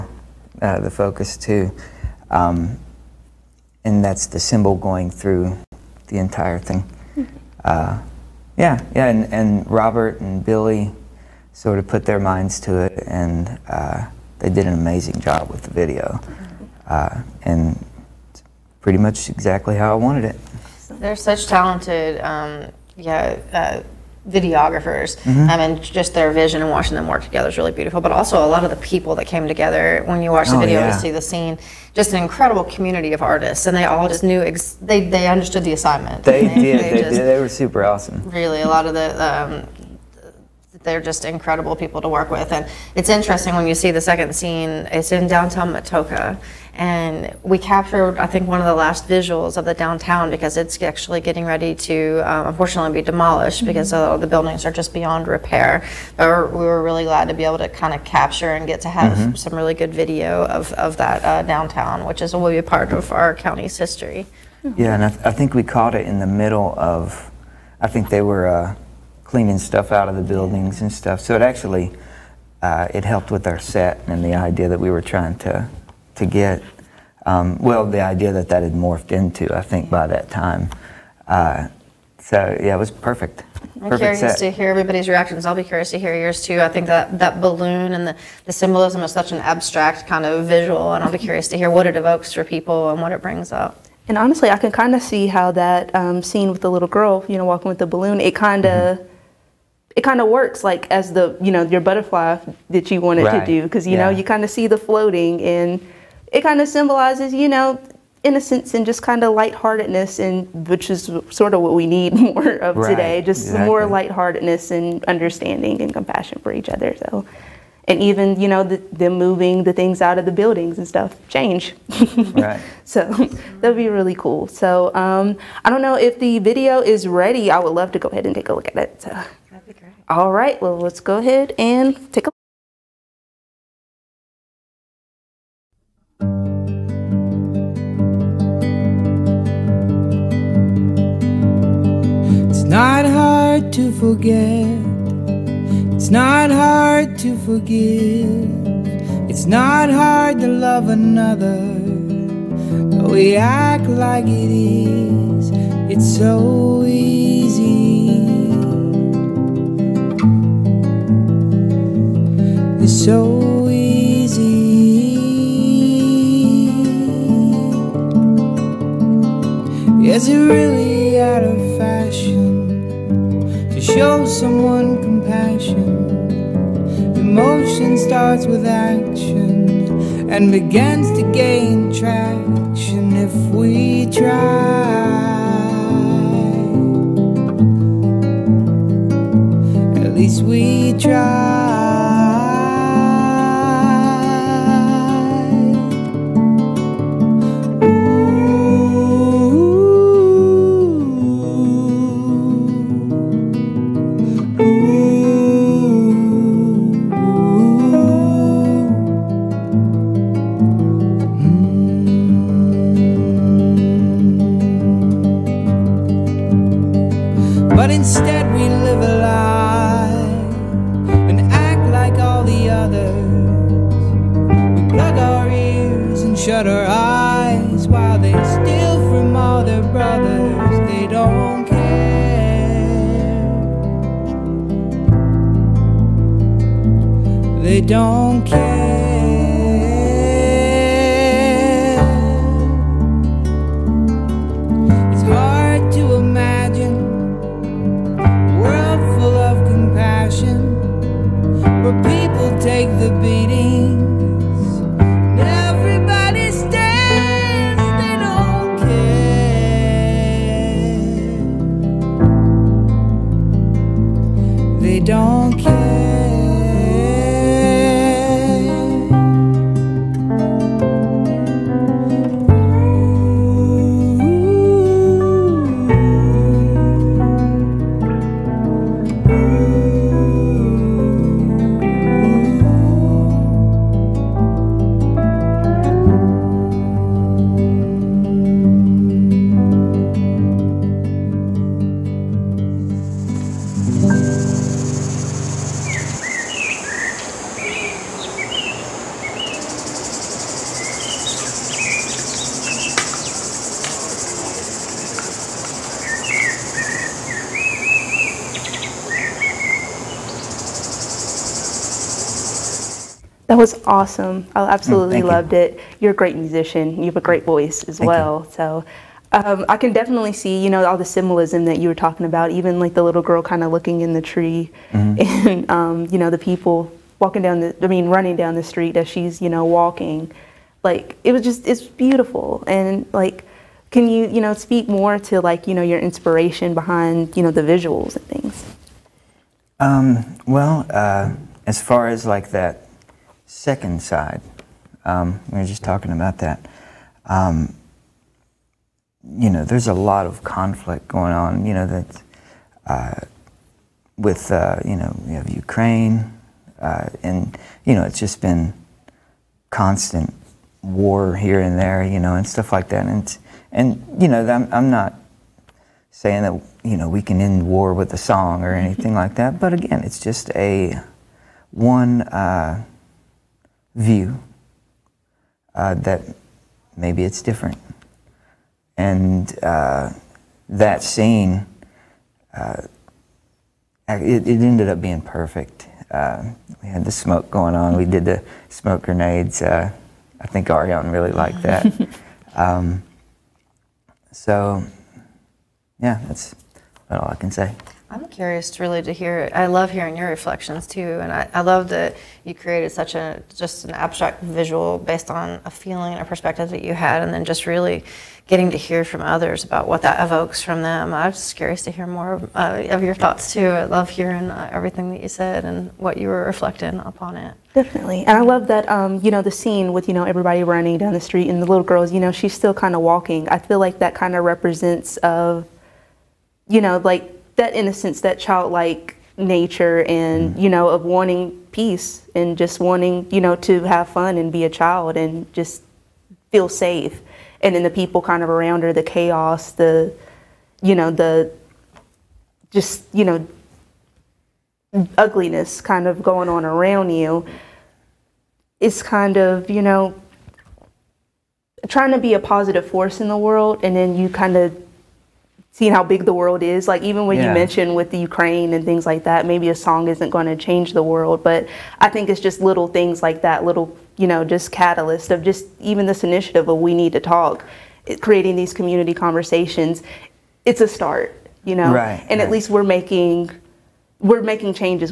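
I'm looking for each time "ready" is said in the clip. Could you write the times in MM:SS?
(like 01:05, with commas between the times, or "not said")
00:51, 02:07.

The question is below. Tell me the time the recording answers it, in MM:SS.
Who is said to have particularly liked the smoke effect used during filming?
06:30.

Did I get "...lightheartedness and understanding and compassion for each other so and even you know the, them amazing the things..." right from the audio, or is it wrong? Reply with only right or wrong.
wrong.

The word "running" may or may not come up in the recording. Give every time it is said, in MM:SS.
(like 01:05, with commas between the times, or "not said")
05:28, 07:00.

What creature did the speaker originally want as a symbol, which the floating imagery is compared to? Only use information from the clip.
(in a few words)
butterfly.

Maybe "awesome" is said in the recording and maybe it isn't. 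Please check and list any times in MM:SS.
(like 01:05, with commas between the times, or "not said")
00:37, 05:13.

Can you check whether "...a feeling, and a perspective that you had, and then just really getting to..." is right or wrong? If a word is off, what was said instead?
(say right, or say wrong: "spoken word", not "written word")
right.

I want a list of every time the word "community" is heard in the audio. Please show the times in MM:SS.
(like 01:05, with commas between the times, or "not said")
00:32, 07:48.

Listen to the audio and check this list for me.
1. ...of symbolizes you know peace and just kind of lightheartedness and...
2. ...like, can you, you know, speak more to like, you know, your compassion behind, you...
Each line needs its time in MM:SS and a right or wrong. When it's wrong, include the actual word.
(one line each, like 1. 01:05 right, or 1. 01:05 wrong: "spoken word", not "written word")
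1. 01:46 wrong: "innocence", not "peace"
2. 05:33 wrong: "inspiration", not "compassion".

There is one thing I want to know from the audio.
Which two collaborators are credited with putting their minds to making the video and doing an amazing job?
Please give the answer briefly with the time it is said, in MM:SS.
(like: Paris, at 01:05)
Robert and Billy, at 00:09.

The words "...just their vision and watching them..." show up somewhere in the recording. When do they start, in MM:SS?
00:25.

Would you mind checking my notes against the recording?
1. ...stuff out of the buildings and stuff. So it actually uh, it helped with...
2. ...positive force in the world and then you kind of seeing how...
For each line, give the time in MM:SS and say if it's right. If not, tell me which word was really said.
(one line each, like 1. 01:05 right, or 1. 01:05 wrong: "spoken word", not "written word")
1. 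01:09 right
2. 07:32 right.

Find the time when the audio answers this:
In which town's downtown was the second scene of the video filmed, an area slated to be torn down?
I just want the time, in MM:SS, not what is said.
00:45.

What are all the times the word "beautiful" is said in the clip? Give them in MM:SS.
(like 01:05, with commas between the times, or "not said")
00:27, 05:31.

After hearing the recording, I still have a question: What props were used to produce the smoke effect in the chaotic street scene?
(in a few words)
smoke grenades.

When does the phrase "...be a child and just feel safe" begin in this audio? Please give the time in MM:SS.
07:14.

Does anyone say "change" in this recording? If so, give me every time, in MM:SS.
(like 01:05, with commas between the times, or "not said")
02:01, 07:40.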